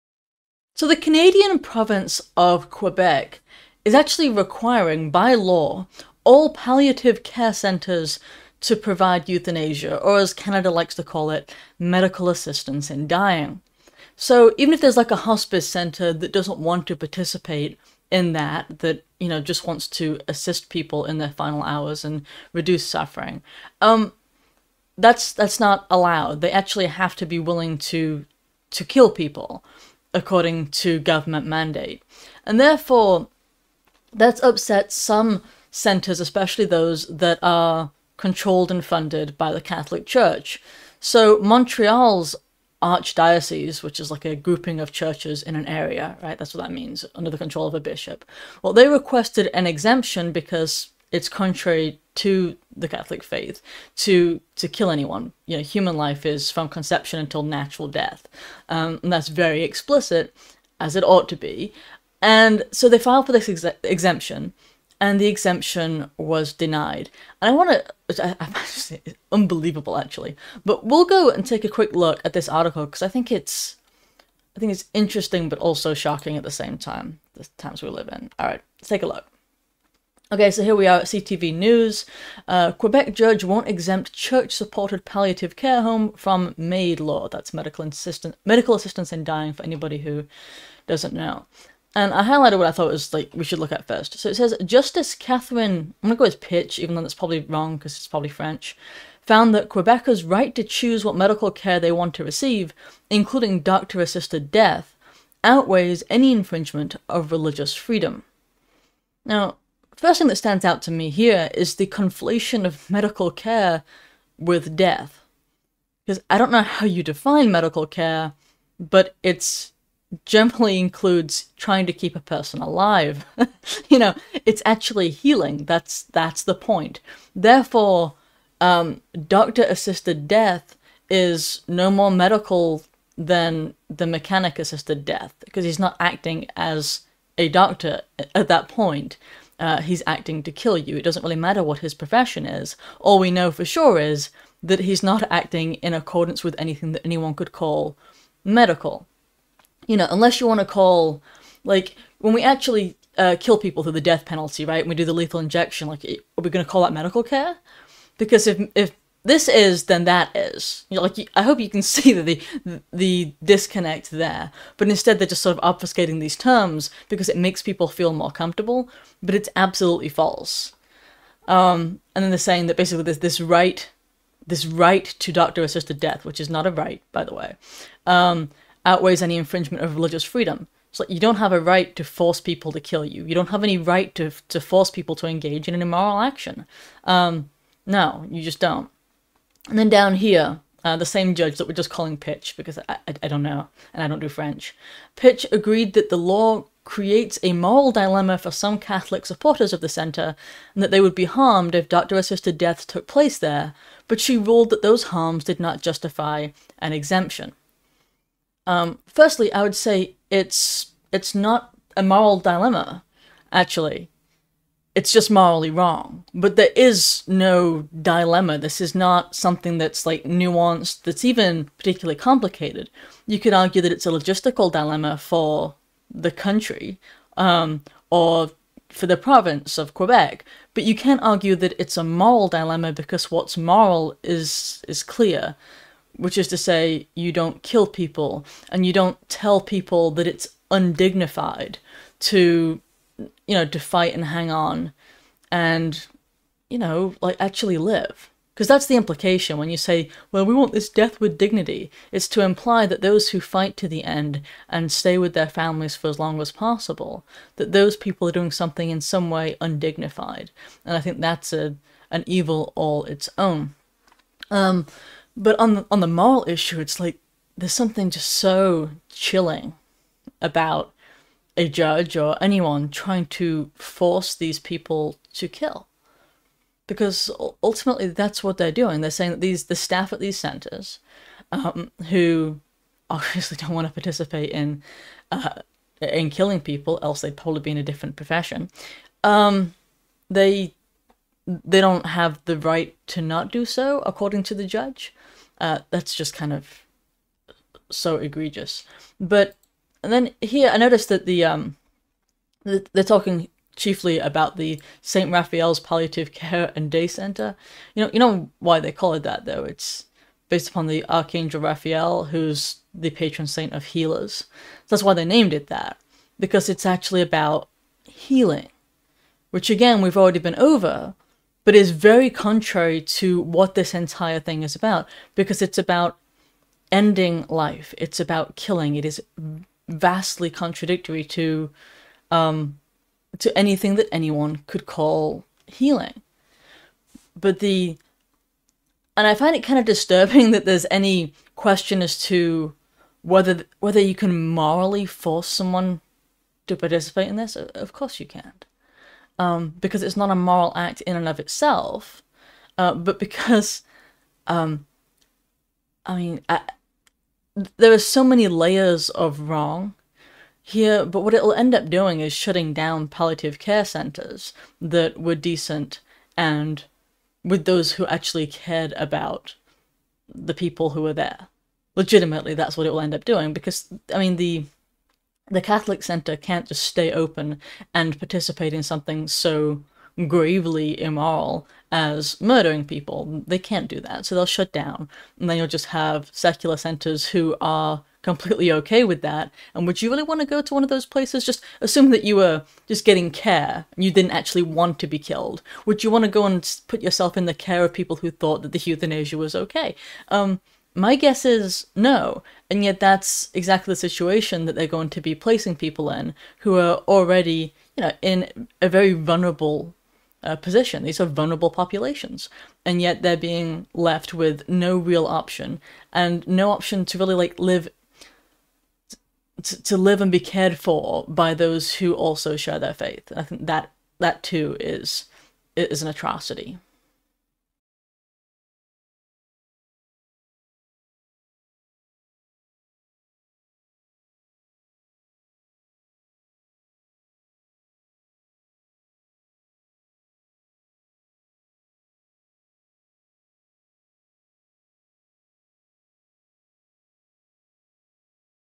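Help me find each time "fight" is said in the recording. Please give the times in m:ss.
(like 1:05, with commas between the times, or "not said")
4:03, 4:13.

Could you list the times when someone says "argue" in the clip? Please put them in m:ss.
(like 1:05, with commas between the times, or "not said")
3:43, 3:51.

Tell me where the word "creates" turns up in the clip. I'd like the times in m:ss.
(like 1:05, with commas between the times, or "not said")
3:16.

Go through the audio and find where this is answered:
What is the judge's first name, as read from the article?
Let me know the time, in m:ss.
1:35.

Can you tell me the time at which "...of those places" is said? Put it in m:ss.
6:30.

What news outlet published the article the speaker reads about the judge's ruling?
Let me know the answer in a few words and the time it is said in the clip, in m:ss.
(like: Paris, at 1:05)
CTV News, at 1:21.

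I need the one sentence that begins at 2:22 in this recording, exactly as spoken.
All we know for sure is that he's not acting in accordance with anything that anyone could call medical.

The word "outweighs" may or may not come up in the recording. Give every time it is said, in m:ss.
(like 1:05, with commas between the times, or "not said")
1:45, 2:58.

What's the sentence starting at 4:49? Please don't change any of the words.
Um, they they don't have the right to not do so, according to the judge.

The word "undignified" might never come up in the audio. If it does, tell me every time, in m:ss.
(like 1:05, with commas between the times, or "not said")
4:00, 4:19.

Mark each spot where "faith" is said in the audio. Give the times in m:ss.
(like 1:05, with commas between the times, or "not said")
0:53, 7:02.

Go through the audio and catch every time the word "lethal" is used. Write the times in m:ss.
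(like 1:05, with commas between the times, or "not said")
2:35.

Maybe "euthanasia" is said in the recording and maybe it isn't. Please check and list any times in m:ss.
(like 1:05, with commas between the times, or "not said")
0:09, 6:38.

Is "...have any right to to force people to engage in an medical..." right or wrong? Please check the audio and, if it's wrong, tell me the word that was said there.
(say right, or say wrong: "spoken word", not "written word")
wrong: "immoral", not "medical".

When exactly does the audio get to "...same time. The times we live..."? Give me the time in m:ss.
1:16.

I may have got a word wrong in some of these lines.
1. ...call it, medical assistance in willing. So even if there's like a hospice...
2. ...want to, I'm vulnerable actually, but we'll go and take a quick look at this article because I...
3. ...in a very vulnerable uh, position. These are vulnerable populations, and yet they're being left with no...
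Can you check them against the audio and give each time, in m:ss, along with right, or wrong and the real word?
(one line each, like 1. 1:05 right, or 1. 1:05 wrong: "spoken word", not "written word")
1. 0:11 wrong: "dying", not "willing"
2. 1:07 wrong: "unbelievable", not "vulnerable"
3. 6:48 right.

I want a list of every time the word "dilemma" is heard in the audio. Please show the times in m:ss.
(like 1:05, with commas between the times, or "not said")
3:17, 3:32, 3:38, 3:44, 3:52.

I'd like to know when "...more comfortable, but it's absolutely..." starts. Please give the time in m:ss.
2:48.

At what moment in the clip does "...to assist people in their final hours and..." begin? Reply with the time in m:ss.
0:19.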